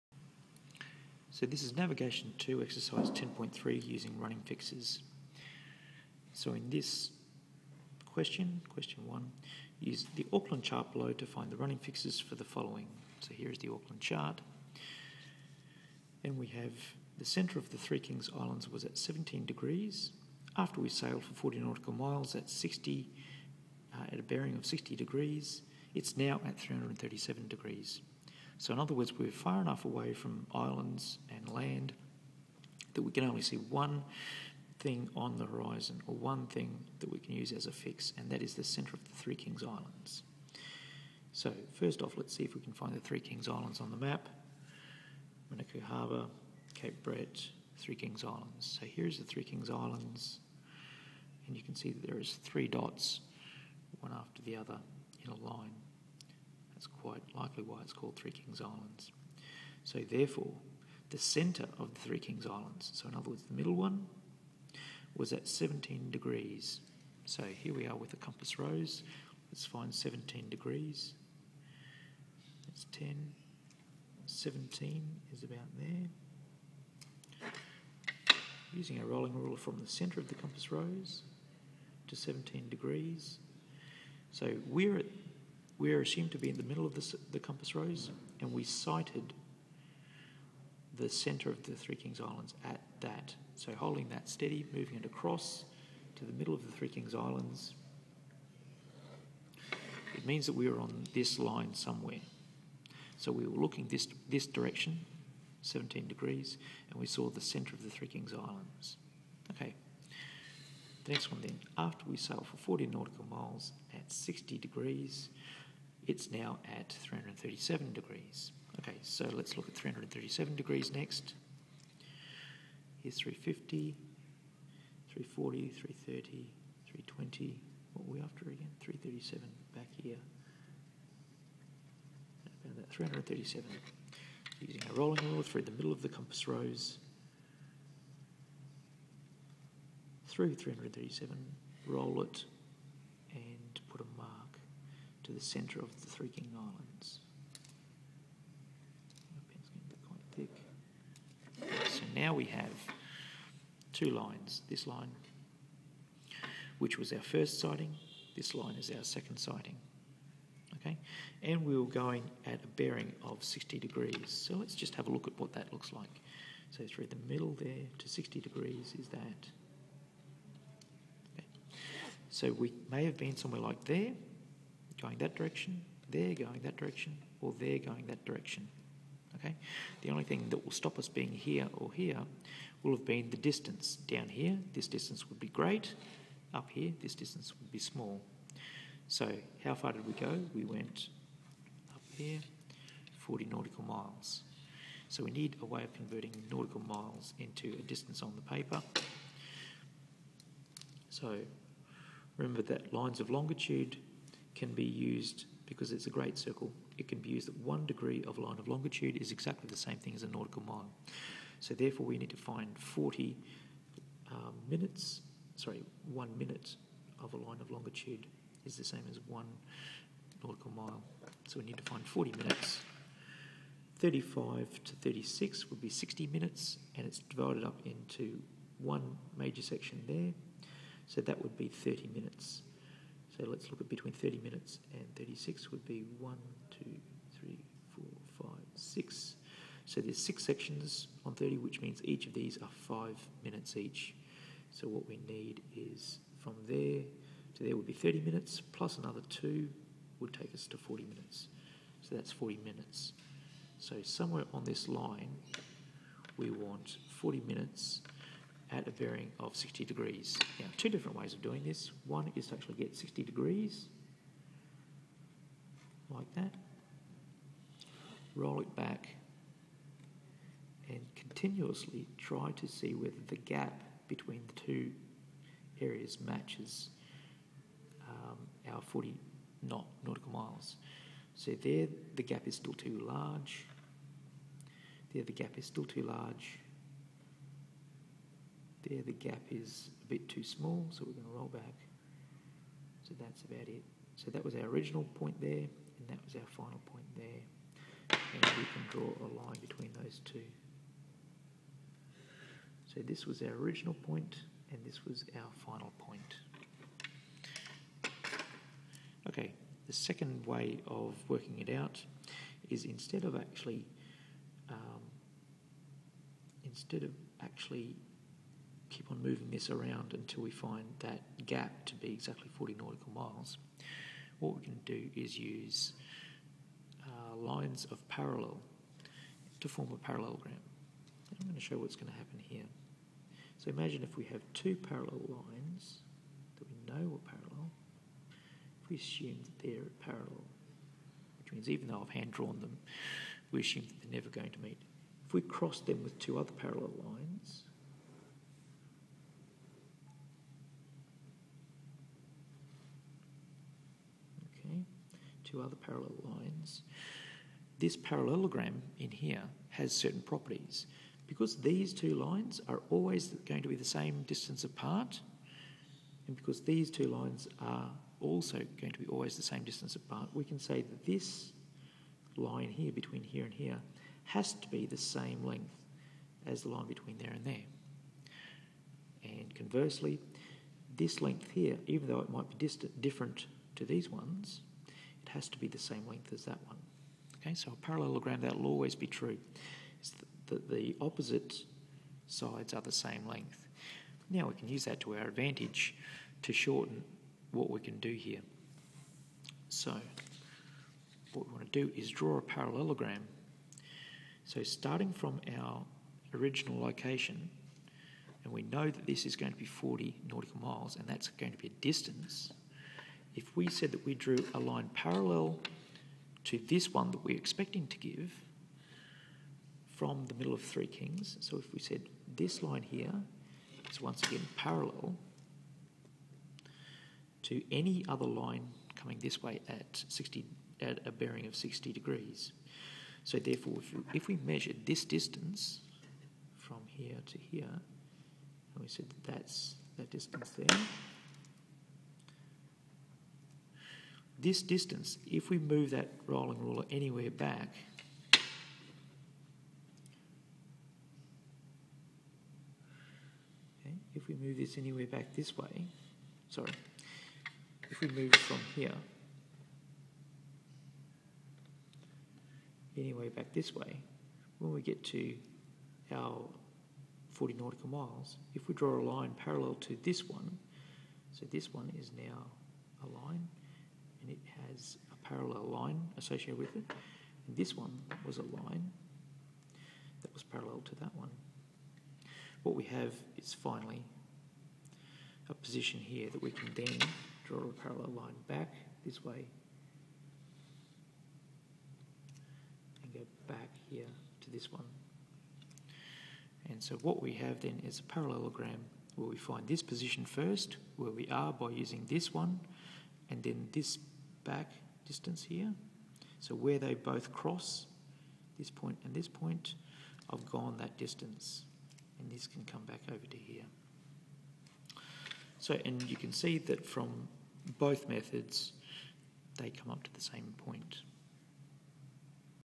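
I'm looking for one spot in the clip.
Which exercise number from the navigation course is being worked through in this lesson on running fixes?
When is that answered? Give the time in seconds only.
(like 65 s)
2 s.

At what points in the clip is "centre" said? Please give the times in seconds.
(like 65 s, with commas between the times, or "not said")
17 s, 38 s, 61 s, 79 s, 91 s, 107 s, 145 s.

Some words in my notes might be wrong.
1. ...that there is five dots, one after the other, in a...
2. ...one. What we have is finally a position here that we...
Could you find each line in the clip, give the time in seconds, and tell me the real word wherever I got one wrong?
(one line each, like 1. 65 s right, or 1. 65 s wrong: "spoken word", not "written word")
1. 51 s wrong: "three", not "five"
2. 481 s right.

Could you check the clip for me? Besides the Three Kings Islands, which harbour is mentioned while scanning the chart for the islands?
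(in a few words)
Manukau Harbour.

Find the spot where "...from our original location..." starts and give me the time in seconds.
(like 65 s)
405 s.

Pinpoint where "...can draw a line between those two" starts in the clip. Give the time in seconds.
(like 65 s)
298 s.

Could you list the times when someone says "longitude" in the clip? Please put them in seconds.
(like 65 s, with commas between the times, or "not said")
203 s, 208 s, 217 s.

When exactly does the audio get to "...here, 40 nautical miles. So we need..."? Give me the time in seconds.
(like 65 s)
192 s.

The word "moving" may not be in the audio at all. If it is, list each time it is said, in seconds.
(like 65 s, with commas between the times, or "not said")
94 s, 319 s.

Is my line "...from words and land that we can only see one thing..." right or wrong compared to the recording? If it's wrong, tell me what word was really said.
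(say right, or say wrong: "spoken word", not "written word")
wrong: "islands", not "words".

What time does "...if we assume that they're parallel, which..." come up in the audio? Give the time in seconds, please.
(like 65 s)
338 s.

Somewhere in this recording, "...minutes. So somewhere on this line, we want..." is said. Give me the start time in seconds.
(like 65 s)
252 s.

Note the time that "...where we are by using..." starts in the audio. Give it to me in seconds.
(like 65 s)
500 s.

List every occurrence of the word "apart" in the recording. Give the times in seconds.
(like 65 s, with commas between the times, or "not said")
364 s, 369 s.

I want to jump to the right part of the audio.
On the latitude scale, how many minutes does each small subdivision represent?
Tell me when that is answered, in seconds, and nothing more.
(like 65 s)
242 s.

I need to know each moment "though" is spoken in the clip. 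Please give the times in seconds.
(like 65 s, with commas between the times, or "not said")
341 s, 382 s.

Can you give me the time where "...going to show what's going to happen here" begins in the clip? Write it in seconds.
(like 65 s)
331 s.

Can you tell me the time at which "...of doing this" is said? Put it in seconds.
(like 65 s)
261 s.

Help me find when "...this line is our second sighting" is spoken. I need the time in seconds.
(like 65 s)
158 s.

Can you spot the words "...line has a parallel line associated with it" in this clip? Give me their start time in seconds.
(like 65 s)
473 s.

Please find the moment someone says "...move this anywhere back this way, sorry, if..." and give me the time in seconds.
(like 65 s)
454 s.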